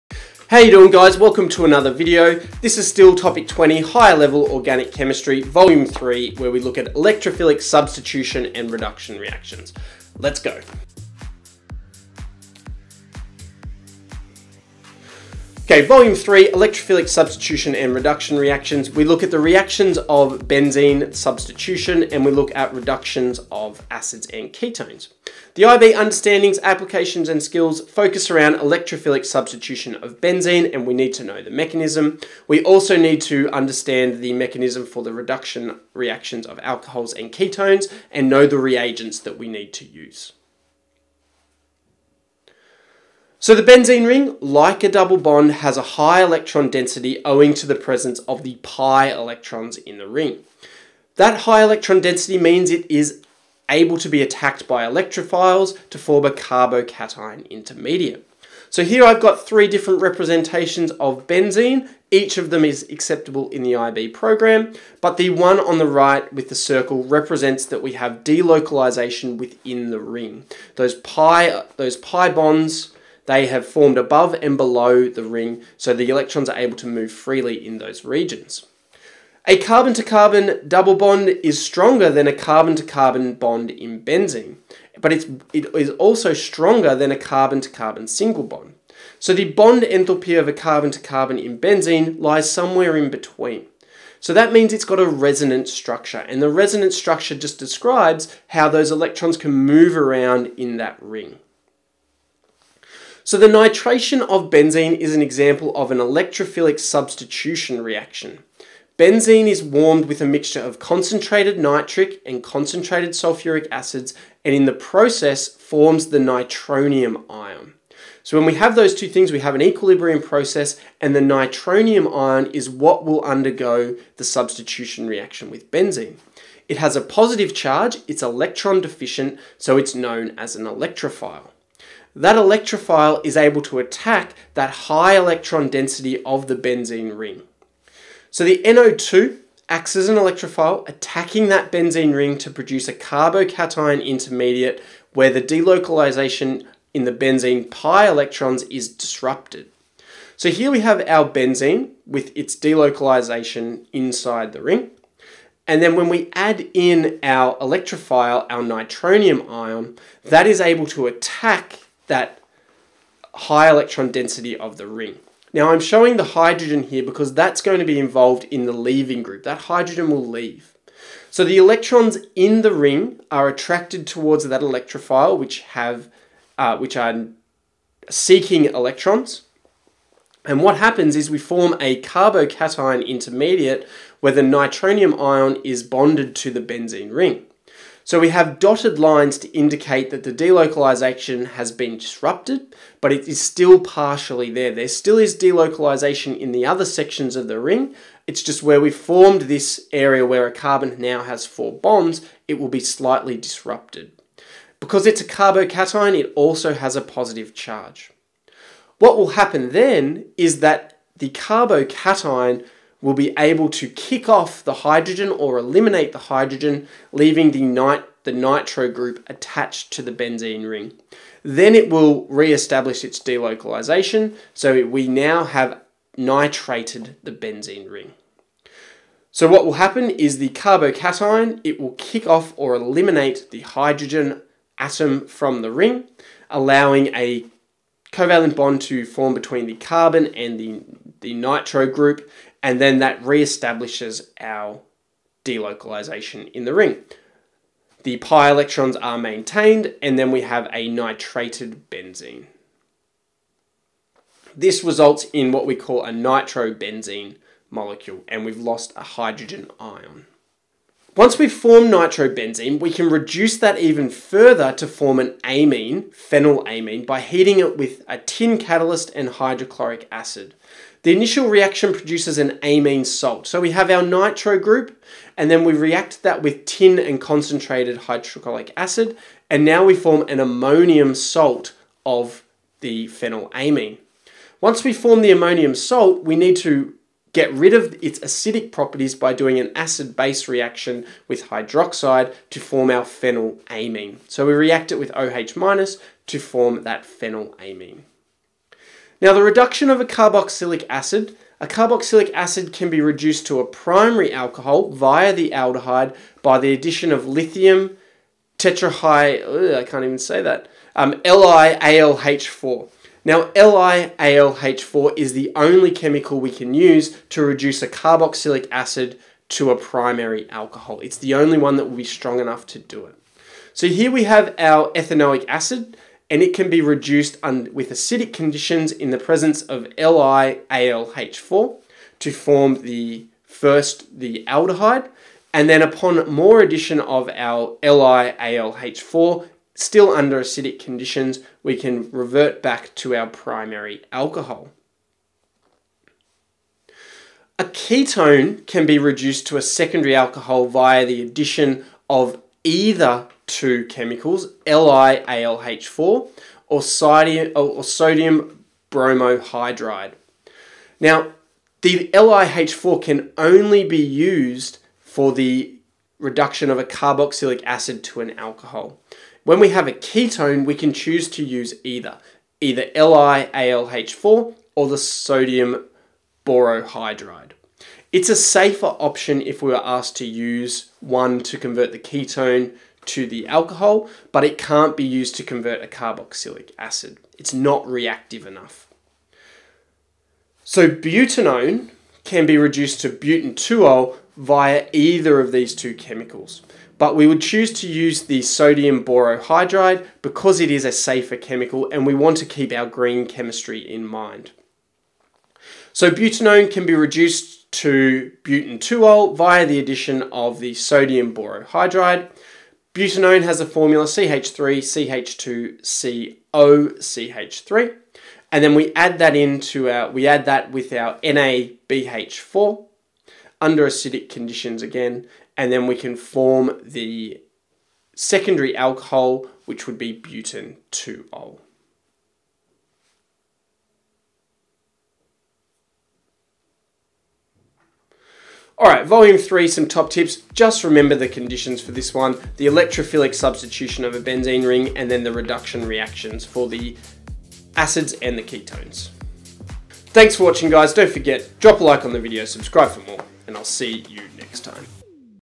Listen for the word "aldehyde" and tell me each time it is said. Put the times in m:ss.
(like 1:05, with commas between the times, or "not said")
5:05, 5:34.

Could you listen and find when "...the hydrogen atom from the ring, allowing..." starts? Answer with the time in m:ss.
3:53.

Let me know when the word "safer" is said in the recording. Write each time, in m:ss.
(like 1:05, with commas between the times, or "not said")
6:18, 6:40.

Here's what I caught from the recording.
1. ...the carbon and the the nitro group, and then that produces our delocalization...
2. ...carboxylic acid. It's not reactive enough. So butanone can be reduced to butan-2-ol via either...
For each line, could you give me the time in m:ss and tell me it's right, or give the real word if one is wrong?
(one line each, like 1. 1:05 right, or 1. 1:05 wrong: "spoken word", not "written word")
1. 3:59 wrong: "reestablishes", not "produces"
2. 6:25 right.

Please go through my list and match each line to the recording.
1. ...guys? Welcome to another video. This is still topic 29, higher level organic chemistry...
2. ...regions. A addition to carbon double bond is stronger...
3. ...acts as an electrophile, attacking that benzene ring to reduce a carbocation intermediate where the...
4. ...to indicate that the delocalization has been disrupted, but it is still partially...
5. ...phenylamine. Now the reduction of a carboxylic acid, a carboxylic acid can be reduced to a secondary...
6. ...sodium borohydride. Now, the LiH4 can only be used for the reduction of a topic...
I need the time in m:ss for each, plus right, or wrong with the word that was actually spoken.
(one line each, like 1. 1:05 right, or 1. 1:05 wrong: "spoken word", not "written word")
1. 0:00 wrong: "20", not "29"
2. 1:18 wrong: "carbon", not "addition"
3. 2:19 wrong: "produce", not "reduce"
4. 3:09 right
5. 4:57 wrong: "primary", not "secondary"
6. 5:57 wrong: "carboxylic", not "topic".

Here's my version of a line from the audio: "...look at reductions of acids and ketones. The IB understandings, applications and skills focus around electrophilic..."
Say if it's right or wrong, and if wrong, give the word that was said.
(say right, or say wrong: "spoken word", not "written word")
right.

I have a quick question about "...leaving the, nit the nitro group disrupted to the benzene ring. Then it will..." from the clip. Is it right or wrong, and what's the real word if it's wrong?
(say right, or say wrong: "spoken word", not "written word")
wrong: "attached", not "disrupted".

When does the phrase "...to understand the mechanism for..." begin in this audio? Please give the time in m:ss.
0:33.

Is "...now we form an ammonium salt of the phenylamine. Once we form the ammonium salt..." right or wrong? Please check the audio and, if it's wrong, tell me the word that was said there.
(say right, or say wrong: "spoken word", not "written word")
right.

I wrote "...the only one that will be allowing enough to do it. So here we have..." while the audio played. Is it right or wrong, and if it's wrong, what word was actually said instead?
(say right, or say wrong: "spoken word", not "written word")
wrong: "strong", not "allowing".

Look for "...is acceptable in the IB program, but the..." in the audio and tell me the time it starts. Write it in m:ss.
1:02.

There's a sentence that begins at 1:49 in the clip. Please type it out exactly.
Benzene is warmed with a mixture of concentrated nitric and concentrated sulfuric acids, and in the process forms the nitronium ion.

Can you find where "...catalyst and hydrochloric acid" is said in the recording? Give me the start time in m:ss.
4:28.